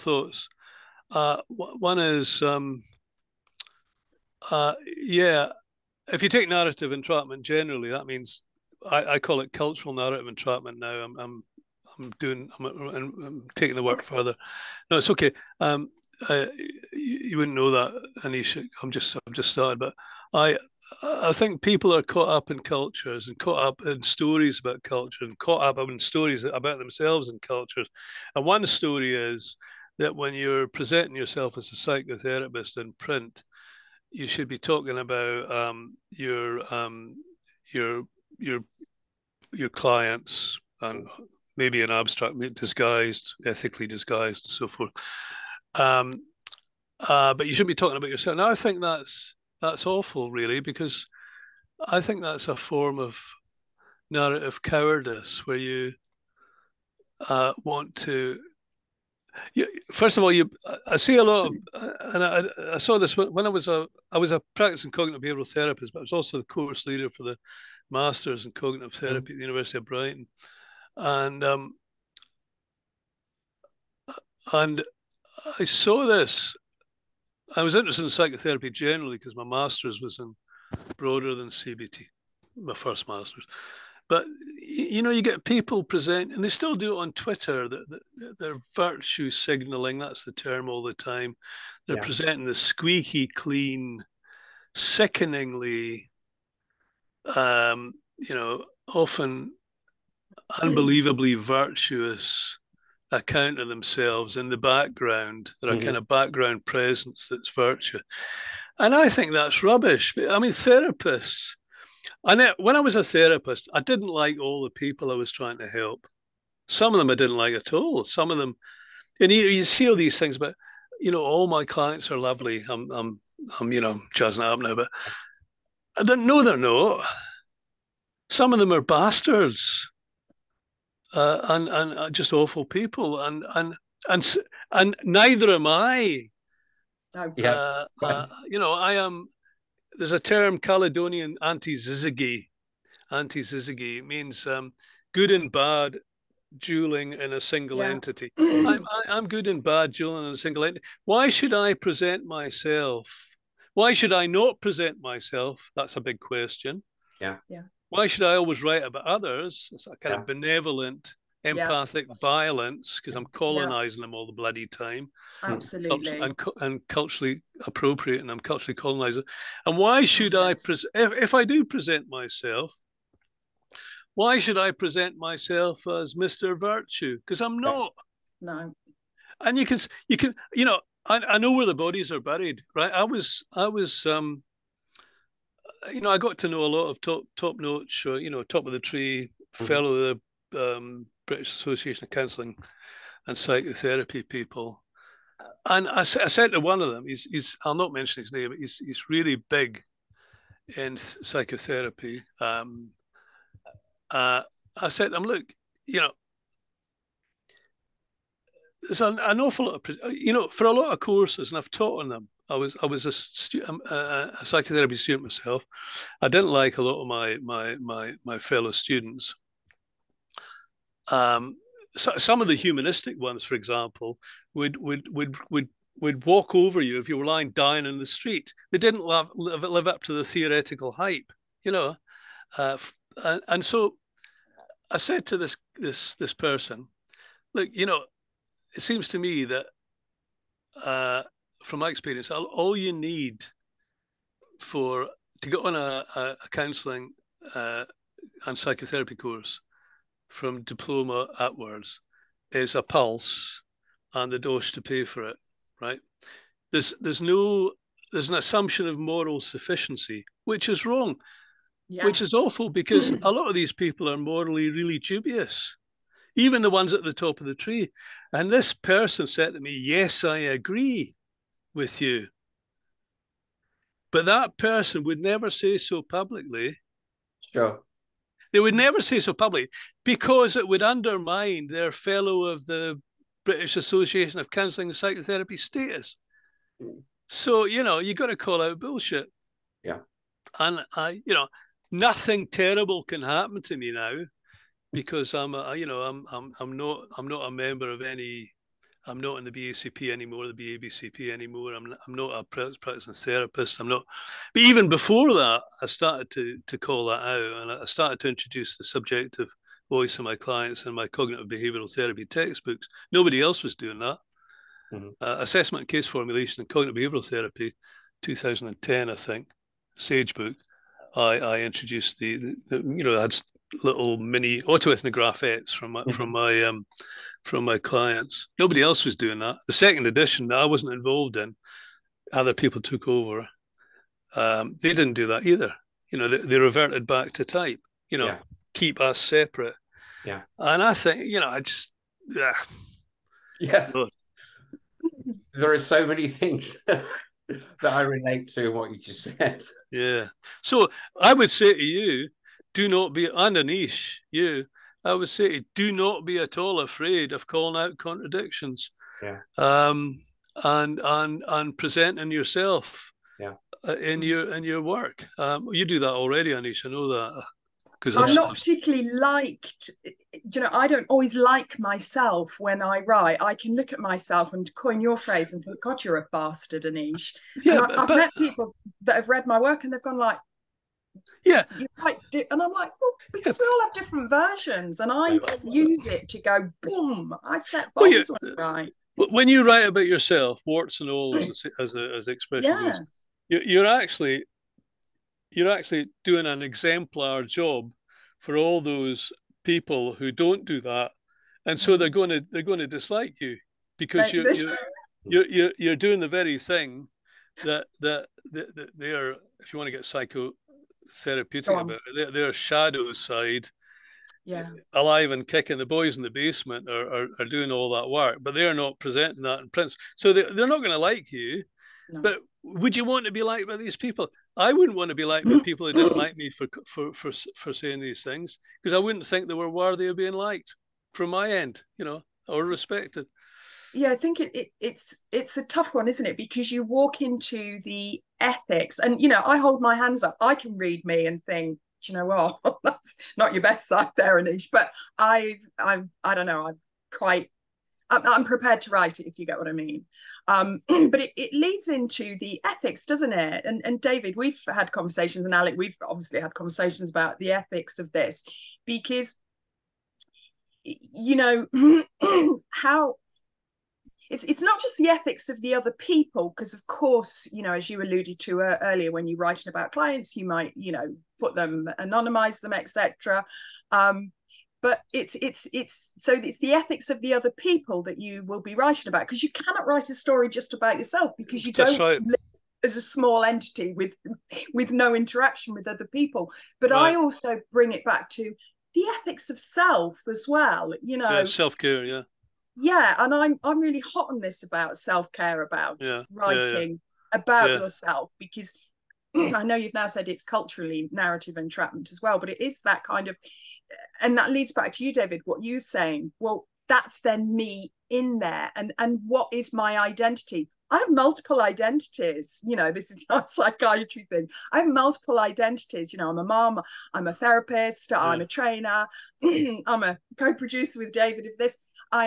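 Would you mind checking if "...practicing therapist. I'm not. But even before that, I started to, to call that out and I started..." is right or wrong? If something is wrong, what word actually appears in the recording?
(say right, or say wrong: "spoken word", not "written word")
right.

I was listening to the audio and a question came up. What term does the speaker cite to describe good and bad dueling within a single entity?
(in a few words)
Caledonian anti-zizigi.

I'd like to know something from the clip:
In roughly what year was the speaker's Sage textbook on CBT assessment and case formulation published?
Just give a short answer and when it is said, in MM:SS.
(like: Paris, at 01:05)
2010, at 05:18.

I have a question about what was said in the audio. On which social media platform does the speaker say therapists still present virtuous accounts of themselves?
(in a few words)
Twitter.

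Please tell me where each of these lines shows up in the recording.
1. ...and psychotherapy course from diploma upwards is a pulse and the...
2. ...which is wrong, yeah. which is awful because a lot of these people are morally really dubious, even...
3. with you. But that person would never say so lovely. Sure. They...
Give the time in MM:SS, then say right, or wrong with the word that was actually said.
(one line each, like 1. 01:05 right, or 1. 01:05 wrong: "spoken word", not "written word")
1. 04:08 right
2. 04:20 right
3. 04:31 wrong: "publicly", not "lovely".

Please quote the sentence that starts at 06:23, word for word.
we all have different versions and i use it to go boom i set bombs well, yeah.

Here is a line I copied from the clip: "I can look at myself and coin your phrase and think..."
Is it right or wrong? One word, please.
right.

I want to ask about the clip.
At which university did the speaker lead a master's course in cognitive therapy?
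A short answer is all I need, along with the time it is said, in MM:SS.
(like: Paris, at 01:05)
University of Brighton, at 01:09.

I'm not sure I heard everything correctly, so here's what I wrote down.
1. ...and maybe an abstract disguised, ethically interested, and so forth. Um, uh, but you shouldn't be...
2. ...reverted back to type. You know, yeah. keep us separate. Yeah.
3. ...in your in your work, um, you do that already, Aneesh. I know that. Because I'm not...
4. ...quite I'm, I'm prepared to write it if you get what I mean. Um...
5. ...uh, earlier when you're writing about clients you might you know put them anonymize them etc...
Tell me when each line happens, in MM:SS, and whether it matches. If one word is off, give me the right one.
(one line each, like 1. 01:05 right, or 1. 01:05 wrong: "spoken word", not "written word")
1. 00:40 wrong: "disguised", not "interested"
2. 05:36 right
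3. 06:03 right
4. 07:27 right
5. 07:48 right.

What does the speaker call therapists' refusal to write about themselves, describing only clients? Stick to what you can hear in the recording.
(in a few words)
narrative cowardice.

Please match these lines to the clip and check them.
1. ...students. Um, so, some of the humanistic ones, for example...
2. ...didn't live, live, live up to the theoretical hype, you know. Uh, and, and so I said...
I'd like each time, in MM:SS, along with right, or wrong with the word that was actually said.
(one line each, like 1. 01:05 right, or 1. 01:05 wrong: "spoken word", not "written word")
1. 03:38 right
2. 03:48 right.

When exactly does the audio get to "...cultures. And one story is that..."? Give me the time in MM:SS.
00:27.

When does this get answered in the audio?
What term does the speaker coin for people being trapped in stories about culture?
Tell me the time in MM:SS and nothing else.
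00:09.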